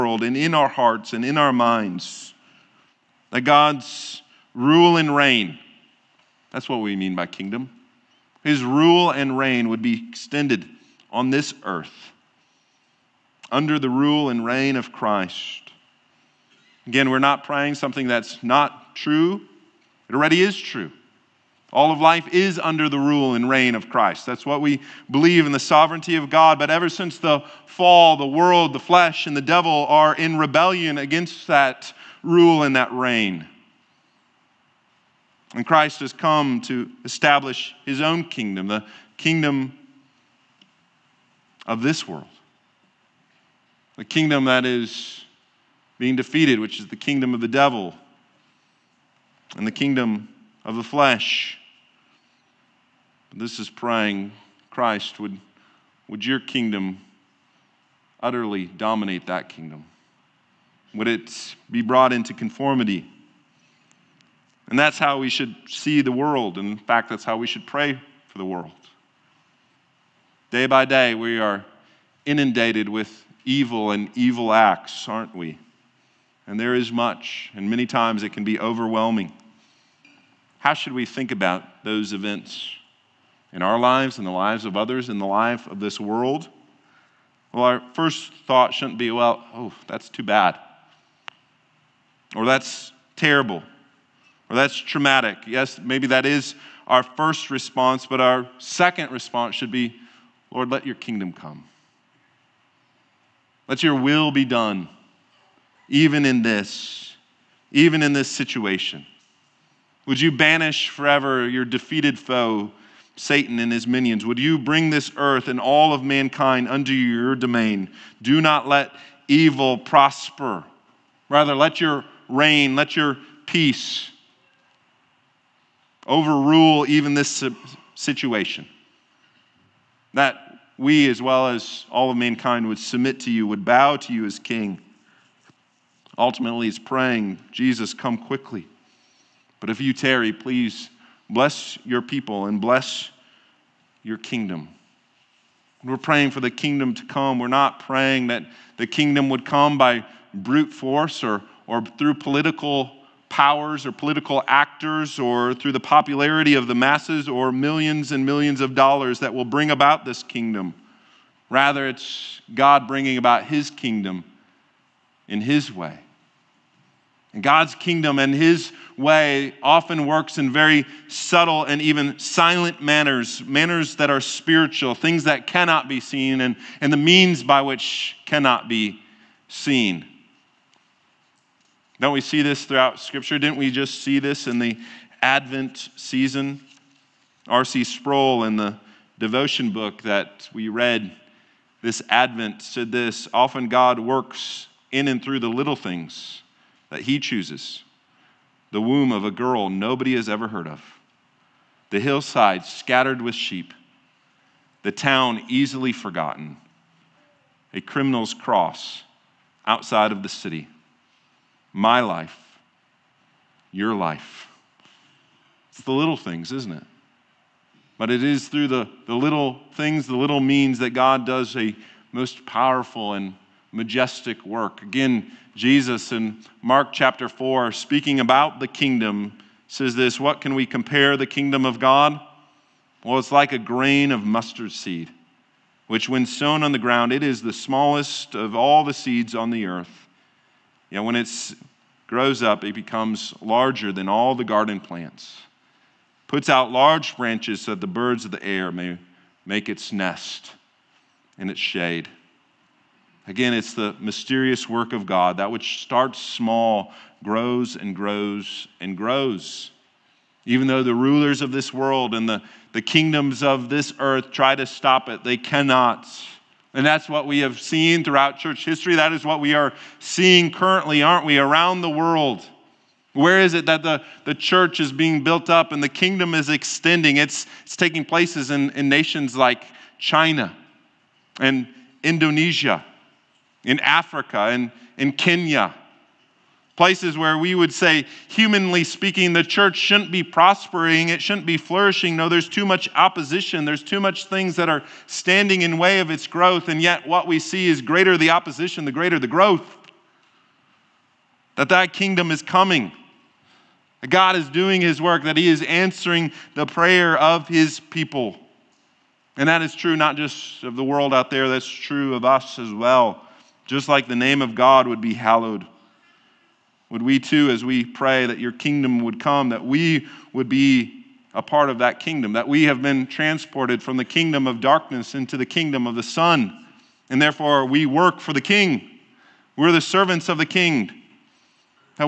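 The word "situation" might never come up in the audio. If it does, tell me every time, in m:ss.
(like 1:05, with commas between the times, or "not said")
1:48, 2:07.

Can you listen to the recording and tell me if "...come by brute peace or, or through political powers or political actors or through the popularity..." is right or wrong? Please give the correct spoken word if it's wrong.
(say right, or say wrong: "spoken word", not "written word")
wrong: "force", not "peace".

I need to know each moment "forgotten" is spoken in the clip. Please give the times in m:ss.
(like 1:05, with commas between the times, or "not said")
3:25.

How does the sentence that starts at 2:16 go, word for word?
Ultimately, he's praying, Jesus, come quickly.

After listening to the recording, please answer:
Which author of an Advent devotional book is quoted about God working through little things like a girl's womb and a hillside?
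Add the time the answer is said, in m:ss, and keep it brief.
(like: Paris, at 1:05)
R.C. Sproul, at 3:07.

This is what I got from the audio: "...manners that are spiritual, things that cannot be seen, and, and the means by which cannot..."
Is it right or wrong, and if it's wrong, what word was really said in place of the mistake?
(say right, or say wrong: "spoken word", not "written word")
right.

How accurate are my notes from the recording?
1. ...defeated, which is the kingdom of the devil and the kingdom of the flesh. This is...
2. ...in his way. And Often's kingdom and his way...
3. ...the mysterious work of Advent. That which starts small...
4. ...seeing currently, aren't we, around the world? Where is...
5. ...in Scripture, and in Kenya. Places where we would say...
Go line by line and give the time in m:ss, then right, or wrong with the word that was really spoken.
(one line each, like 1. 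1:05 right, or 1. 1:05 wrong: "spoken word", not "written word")
1. 0:46 right
2. 2:45 wrong: "God", not "Often"
3. 4:13 wrong: "God", not "Advent"
4. 4:29 right
5. 4:43 wrong: "Africa", not "Scripture".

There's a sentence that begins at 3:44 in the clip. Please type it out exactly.
Again, Jesus in Mark chapter 4, speaking about the kingdom, says this What can we compare the kingdom of God?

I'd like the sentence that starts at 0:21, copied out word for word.
All of life is under the rule and reign of Christ.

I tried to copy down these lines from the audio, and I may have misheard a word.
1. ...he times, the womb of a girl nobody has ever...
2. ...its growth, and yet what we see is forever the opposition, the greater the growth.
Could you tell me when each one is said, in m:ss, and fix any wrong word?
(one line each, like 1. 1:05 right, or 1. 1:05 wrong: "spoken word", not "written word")
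1. 3:17 wrong: "chooses", not "times"
2. 4:56 wrong: "greater", not "forever".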